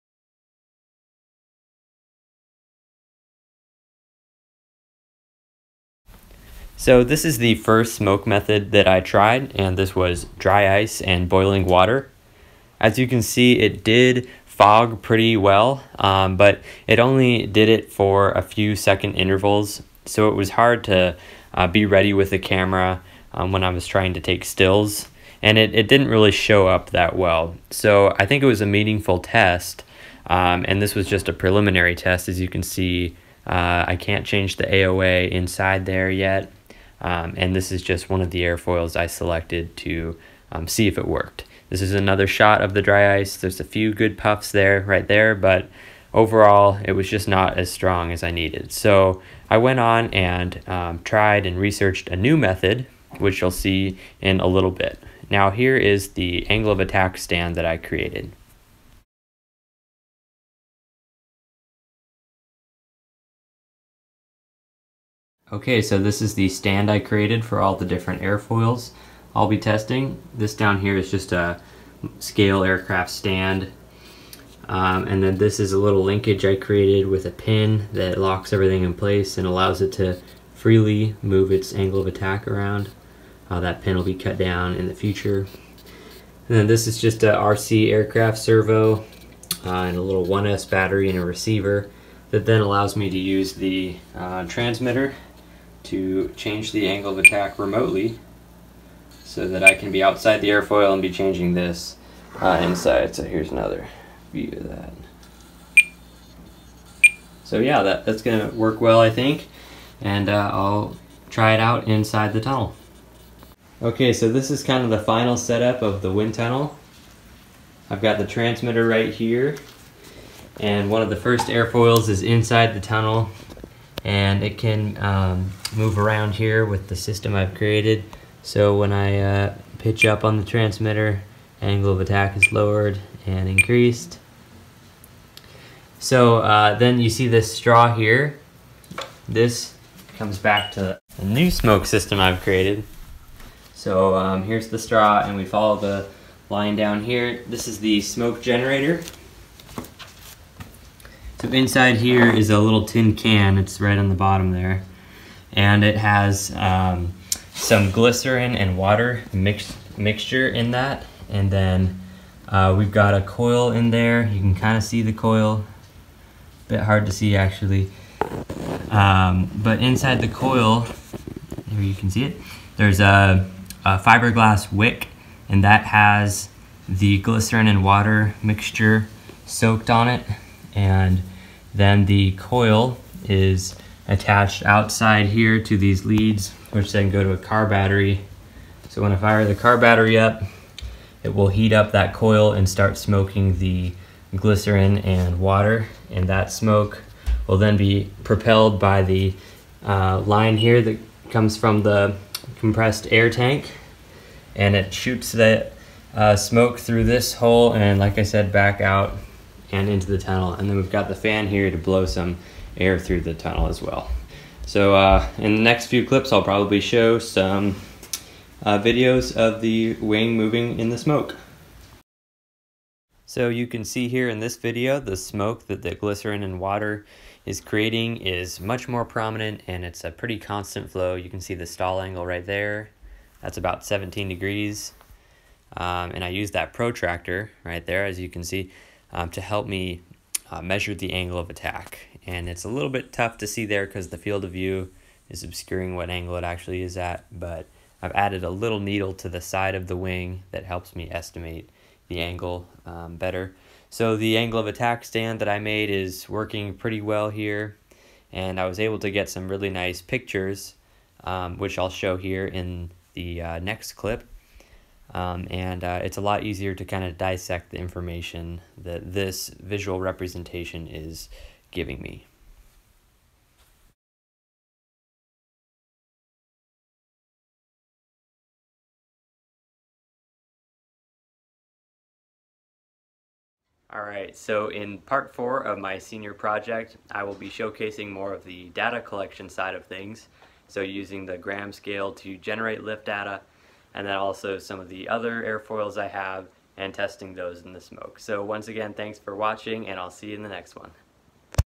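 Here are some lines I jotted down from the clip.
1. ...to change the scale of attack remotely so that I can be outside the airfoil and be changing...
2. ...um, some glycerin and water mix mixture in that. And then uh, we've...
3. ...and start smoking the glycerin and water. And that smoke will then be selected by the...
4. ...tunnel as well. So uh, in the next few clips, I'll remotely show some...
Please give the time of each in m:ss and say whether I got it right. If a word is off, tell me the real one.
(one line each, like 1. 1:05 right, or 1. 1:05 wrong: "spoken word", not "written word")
1. 1:35 wrong: "angle", not "scale"
2. 2:36 right
3. 3:12 wrong: "propelled", not "selected"
4. 3:33 wrong: "probably", not "remotely".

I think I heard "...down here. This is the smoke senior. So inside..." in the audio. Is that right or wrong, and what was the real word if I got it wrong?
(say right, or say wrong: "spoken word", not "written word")
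wrong: "generator", not "senior".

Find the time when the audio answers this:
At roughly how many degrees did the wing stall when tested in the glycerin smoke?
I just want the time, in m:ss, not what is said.
3:53.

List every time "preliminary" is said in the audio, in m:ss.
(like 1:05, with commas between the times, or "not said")
0:31.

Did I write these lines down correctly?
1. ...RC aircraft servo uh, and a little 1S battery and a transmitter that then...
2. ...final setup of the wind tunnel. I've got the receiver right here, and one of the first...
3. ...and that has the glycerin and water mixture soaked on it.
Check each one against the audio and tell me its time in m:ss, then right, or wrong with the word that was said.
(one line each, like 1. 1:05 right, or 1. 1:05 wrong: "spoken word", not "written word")
1. 1:27 wrong: "receiver", not "transmitter"
2. 1:54 wrong: "transmitter", not "receiver"
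3. 2:55 right.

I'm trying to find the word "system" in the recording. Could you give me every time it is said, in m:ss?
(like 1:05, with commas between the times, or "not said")
2:06, 2:21.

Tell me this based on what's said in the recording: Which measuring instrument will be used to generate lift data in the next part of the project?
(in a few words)
Gram scale.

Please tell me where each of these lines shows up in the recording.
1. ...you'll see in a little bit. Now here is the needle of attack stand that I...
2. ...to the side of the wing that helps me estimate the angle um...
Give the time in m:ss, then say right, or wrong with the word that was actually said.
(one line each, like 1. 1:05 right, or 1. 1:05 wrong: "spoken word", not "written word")
1. 0:53 wrong: "angle", not "needle"
2. 4:09 right.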